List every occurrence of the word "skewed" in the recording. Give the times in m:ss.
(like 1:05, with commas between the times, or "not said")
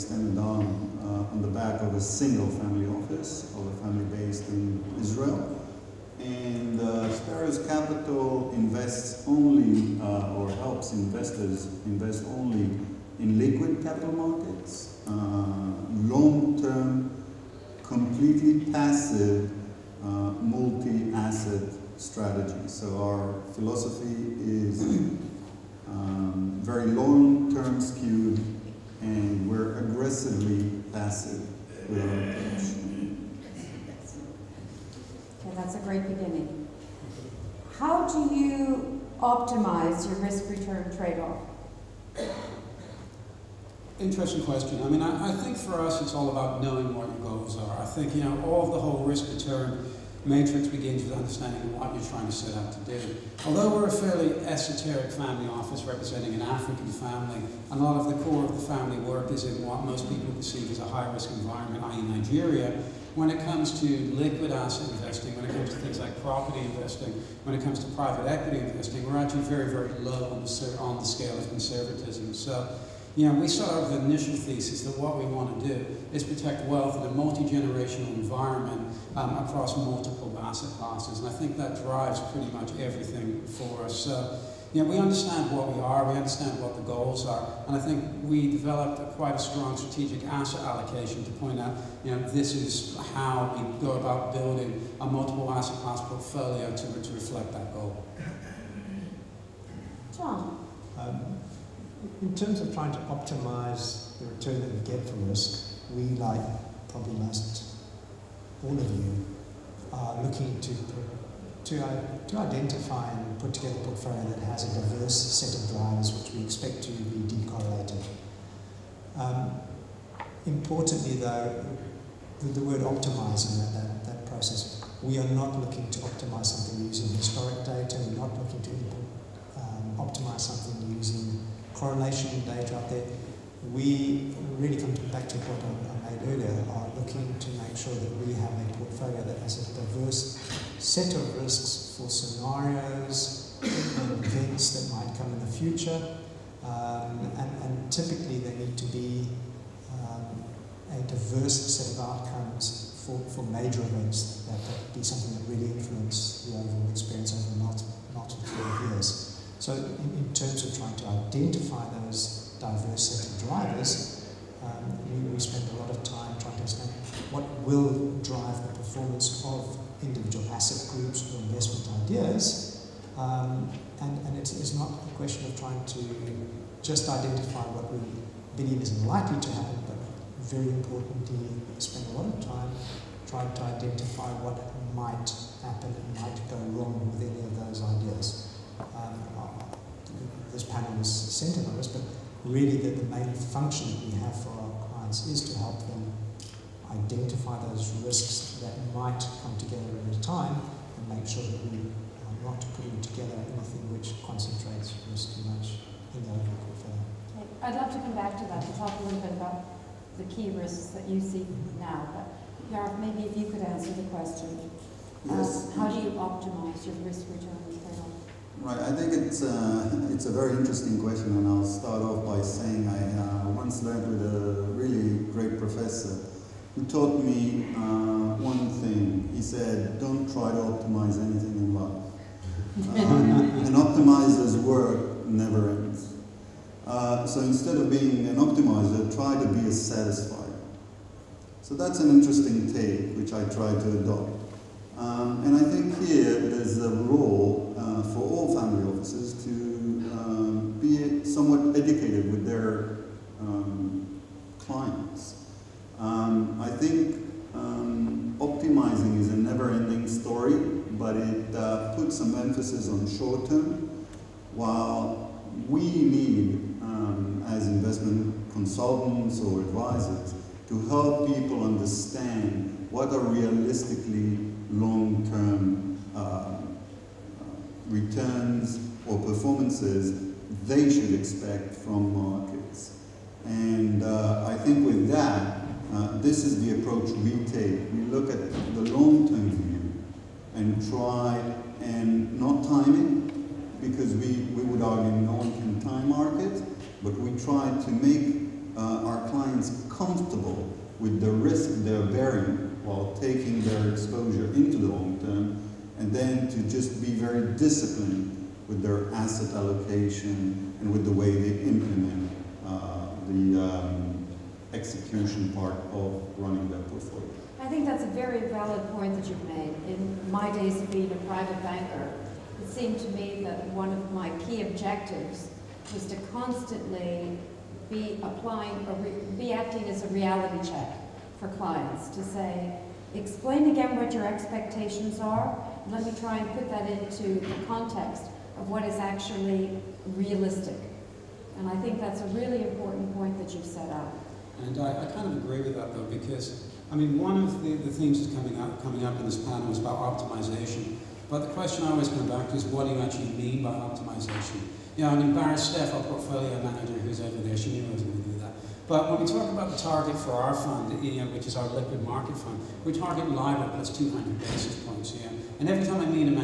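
0:27.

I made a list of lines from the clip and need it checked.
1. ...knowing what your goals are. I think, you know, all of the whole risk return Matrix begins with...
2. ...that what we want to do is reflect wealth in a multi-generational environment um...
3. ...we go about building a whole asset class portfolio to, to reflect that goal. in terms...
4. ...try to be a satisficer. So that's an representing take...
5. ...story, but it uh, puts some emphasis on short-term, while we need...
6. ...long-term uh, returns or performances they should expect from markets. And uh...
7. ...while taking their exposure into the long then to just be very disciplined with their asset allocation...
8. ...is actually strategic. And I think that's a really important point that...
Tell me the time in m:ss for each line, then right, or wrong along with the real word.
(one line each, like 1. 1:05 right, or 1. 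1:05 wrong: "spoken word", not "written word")
1. 0:46 right
2. 1:14 wrong: "protect", not "reflect"
3. 1:33 wrong: "multiple", not "whole"
4. 3:59 wrong: "interesting", not "representing"
5. 4:20 right
6. 4:34 right
7. 5:02 right
8. 5:38 wrong: "realistic", not "strategic".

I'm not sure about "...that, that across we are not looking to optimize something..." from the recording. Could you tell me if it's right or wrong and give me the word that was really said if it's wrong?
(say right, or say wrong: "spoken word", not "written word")
wrong: "process", not "across".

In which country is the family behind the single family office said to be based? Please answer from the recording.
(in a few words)
Israel.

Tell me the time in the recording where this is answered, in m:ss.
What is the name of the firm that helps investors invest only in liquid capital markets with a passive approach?
0:07.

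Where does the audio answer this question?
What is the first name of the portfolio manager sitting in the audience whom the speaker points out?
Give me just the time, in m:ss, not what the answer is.
5:55.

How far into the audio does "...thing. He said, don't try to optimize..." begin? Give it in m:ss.
3:48.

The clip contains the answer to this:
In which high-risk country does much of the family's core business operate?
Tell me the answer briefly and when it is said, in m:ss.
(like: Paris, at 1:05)
Nigeria, at 1:02.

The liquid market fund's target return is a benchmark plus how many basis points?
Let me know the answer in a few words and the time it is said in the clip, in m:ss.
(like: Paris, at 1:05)
200, at 6:03.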